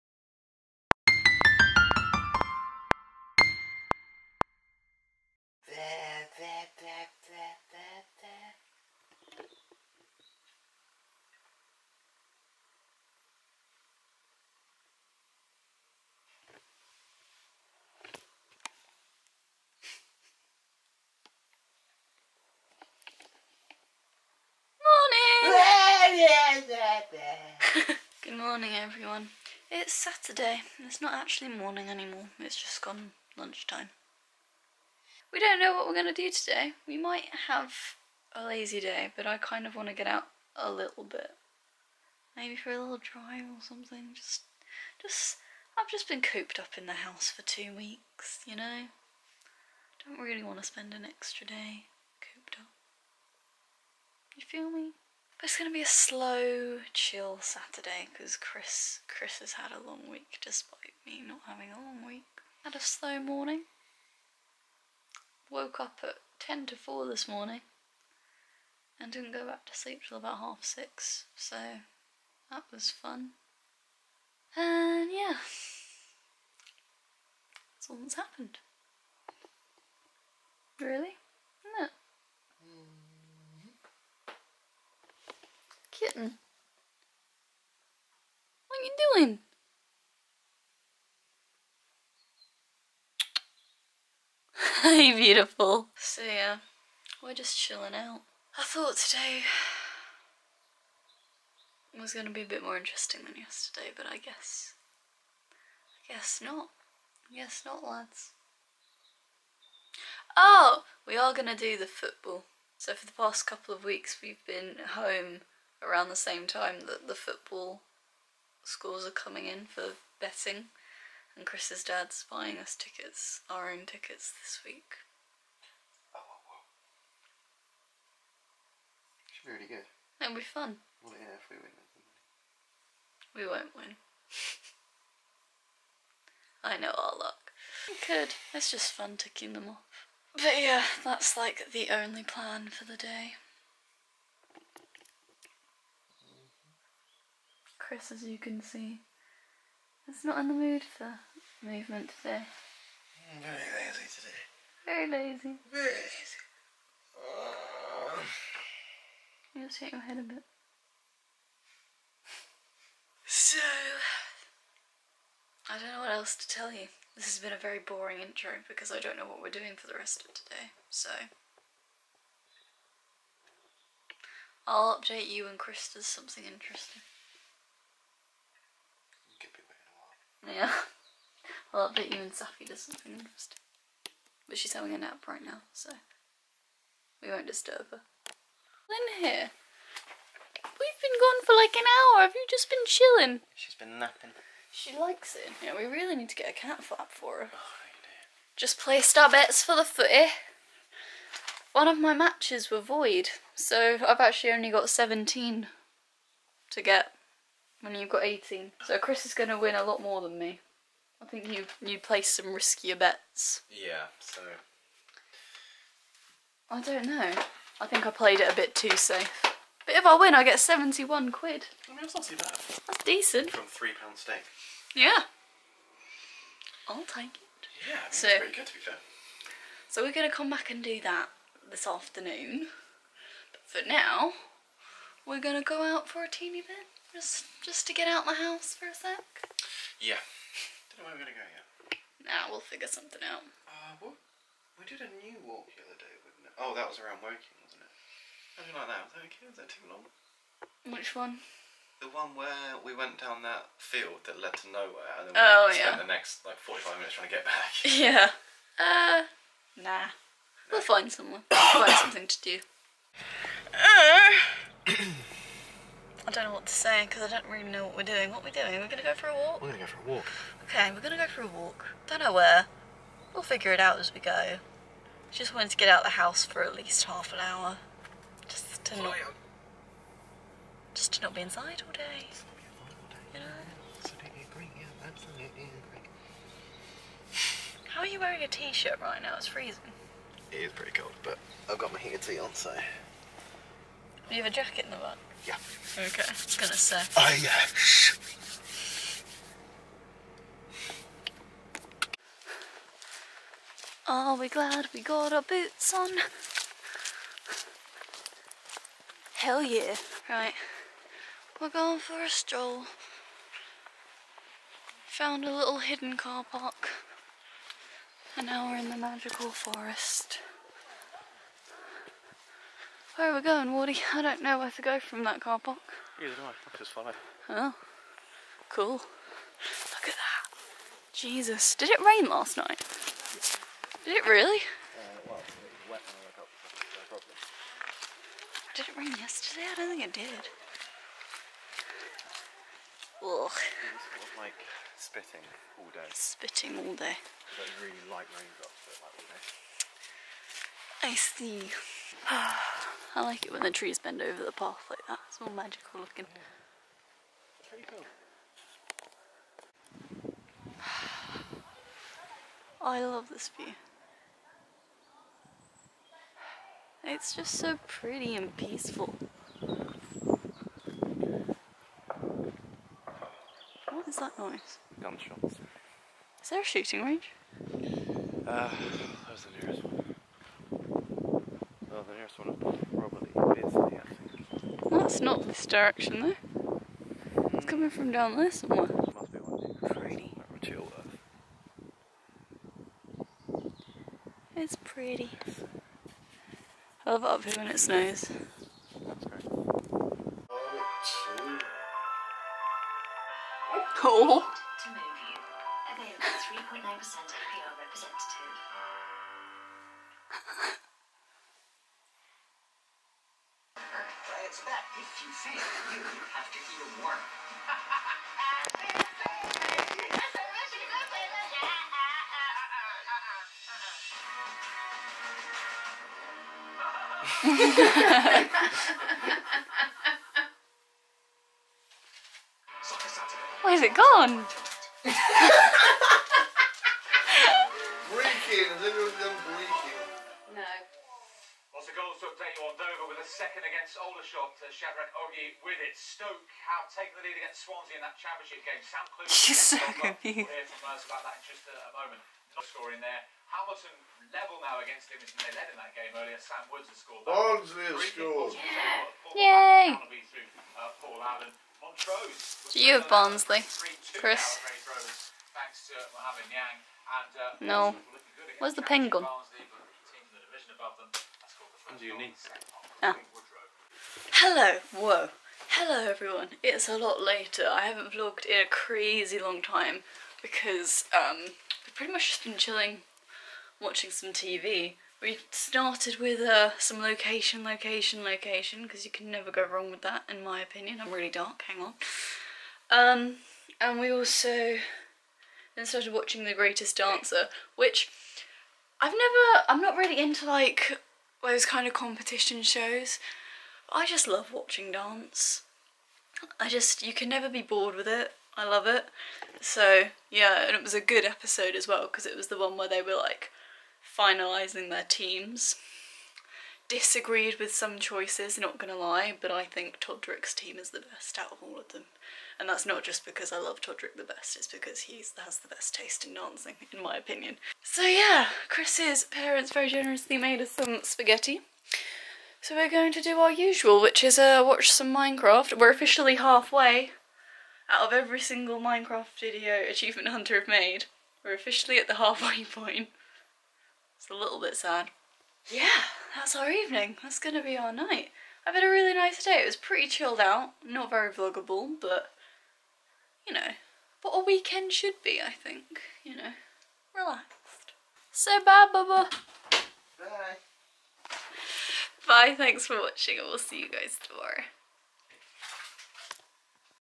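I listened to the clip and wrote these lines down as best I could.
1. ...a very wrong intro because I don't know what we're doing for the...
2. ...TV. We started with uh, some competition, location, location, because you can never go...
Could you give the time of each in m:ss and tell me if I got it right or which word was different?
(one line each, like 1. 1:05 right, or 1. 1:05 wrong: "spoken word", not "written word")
1. 2:47 wrong: "boring", not "wrong"
2. 8:04 wrong: "location", not "competition".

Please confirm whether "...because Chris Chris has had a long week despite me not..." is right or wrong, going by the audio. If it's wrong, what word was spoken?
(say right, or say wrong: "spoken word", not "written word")
right.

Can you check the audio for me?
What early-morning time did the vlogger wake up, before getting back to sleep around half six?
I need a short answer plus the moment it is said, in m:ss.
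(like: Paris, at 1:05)
10 to 4, at 1:06.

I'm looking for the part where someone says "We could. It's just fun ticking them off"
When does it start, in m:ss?
2:17.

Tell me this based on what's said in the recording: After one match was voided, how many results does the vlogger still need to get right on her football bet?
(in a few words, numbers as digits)
17.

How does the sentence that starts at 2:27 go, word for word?
Chris, as you can see, is not in the mood for movement today.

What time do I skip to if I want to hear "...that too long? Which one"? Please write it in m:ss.
4:09.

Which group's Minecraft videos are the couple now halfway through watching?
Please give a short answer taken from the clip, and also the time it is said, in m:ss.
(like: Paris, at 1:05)
Achievement Hunter, at 8:59.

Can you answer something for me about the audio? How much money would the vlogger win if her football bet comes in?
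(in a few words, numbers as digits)
£71.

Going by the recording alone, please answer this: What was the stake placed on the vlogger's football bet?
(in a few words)
£3.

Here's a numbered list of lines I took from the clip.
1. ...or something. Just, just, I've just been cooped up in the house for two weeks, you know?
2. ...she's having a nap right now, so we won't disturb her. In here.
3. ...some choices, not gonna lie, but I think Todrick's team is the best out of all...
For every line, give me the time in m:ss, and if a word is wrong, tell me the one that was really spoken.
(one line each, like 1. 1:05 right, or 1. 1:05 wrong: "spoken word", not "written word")
1. 0:43 right
2. 3:04 right
3. 8:37 right.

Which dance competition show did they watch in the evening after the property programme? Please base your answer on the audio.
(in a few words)
The Greatest Dancer.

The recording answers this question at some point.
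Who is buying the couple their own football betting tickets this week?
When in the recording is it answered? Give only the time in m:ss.
2:01.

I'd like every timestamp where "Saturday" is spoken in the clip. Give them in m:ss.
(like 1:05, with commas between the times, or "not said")
0:29, 0:57.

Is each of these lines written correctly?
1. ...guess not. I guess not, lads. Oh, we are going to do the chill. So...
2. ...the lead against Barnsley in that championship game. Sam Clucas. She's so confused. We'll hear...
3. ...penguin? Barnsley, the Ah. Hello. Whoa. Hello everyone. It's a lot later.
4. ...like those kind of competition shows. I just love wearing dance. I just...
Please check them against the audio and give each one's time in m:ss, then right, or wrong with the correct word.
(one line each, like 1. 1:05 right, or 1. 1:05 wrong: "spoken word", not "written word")
1. 1:46 wrong: "football", not "chill"
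2. 7:27 wrong: "Swansea", not "Barnsley"
3. 7:48 right
4. 8:20 wrong: "watching", not "wearing".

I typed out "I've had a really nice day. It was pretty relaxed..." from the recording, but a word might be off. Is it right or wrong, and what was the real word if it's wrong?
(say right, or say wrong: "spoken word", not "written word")
wrong: "chilled", not "relaxed".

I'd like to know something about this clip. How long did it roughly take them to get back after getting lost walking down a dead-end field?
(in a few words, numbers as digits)
45 minutes.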